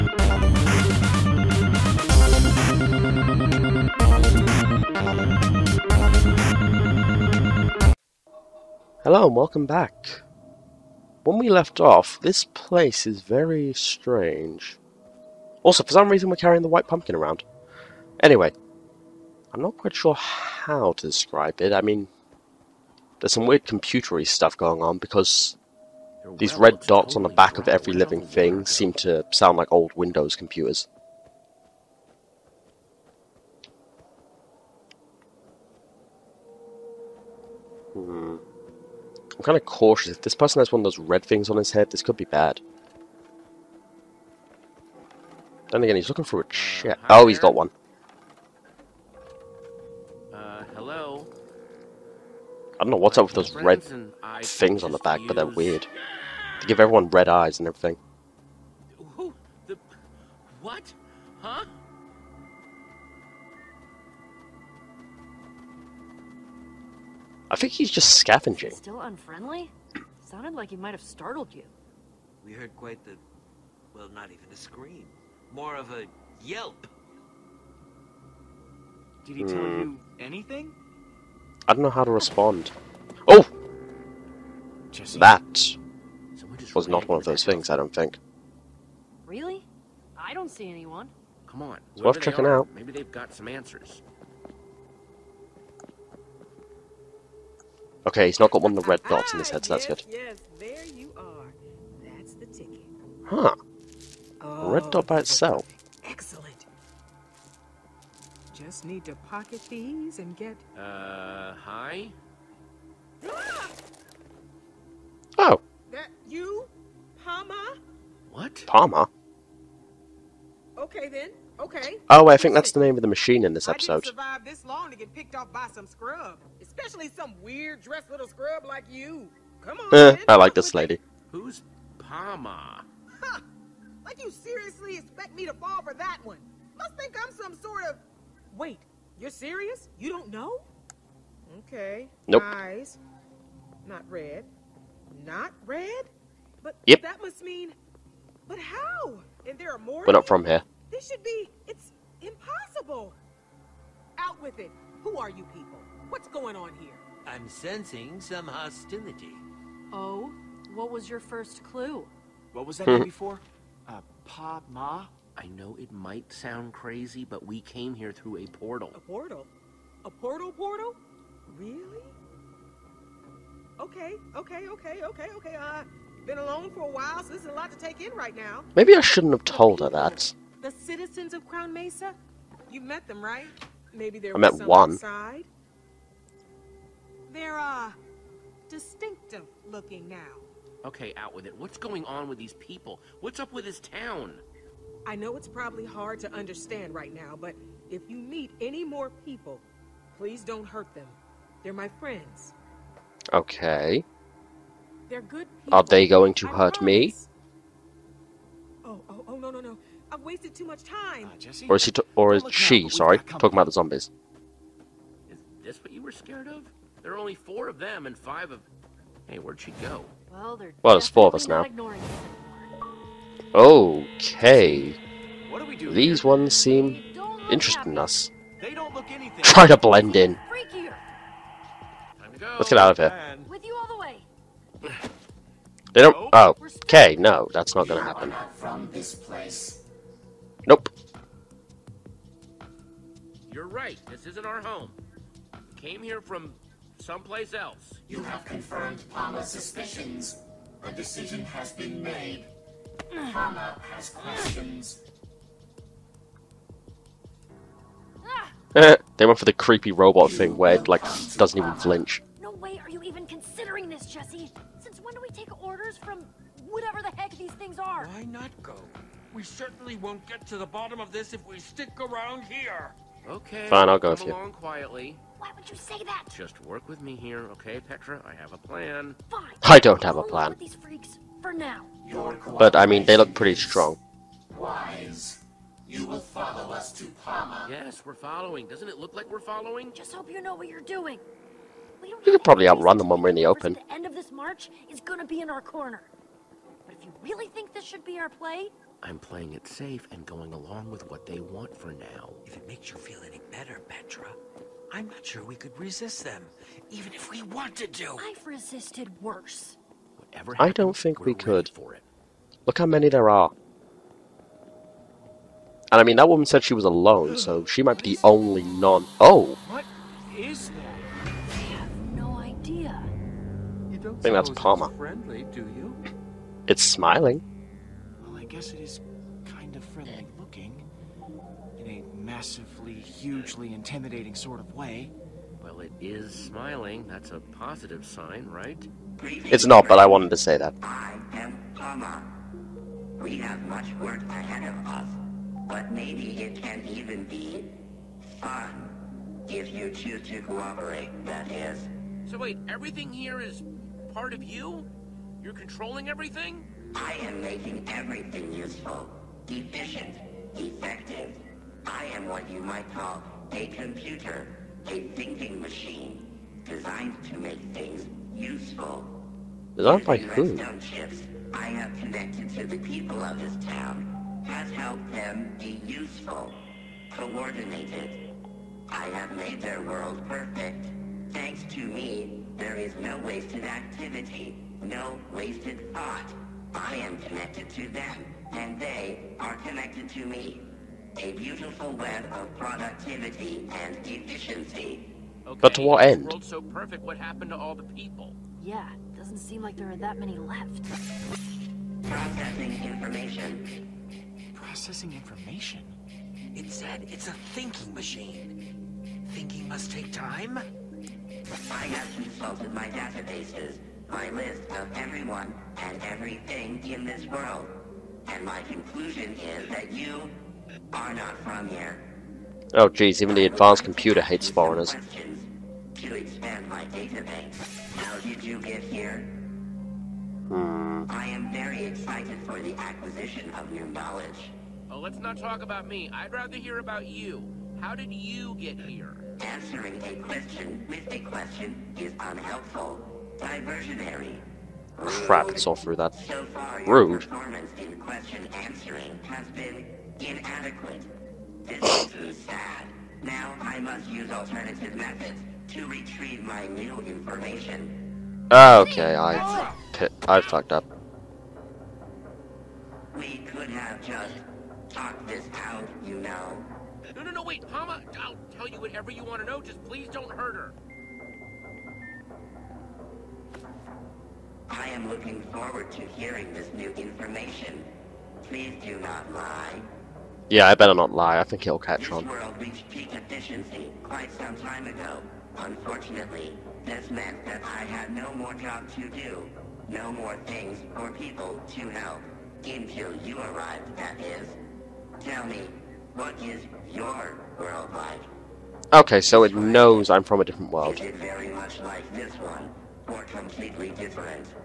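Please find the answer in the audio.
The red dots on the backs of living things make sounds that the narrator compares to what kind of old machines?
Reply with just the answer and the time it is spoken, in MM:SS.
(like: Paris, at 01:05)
old Windows computers, at 00:29.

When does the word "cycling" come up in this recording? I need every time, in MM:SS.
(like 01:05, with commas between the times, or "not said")
not said.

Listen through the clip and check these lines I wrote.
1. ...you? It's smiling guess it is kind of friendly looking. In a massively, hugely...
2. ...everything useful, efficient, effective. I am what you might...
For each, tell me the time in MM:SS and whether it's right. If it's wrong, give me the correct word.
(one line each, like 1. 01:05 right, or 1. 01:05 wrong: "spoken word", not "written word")
1. 05:25 right
2. 05:57 right.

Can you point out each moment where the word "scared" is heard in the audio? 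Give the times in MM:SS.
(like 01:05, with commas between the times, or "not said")
03:36.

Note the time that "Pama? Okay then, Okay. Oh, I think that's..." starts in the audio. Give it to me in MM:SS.
01:58.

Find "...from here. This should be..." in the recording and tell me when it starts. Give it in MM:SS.
02:30.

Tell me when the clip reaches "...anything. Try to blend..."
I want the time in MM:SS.
03:49.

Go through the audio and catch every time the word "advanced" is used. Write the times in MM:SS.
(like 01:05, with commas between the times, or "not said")
07:03.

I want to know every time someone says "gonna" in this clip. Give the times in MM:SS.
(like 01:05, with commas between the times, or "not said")
03:57, 04:55.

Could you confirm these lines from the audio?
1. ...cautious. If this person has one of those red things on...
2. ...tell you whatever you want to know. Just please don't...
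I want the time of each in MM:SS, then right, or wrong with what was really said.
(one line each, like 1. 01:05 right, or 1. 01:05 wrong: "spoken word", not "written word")
1. 00:39 right
2. 07:48 right.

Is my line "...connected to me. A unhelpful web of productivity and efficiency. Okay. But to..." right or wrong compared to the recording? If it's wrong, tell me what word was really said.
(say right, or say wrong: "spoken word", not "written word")
wrong: "beautiful", not "unhelpful".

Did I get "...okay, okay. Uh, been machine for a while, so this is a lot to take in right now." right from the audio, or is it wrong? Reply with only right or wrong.
wrong.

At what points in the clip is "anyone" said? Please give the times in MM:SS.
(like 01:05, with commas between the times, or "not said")
01:30.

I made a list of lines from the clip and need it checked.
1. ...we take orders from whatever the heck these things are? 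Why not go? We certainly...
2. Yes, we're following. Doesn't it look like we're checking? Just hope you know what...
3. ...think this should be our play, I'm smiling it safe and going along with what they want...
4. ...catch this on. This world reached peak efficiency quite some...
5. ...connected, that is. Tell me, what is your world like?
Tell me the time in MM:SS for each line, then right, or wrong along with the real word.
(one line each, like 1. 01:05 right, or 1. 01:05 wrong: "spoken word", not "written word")
1. 04:25 right
2. 04:47 wrong: "following", not "checking"
3. 04:57 wrong: "playing", not "smiling"
4. 08:01 right
5. 08:13 wrong: "arrived", not "connected".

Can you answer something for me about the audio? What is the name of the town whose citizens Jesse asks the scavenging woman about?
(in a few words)
Crown Mesa.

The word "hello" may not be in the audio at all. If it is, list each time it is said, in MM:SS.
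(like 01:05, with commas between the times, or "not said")
00:09, 00:50.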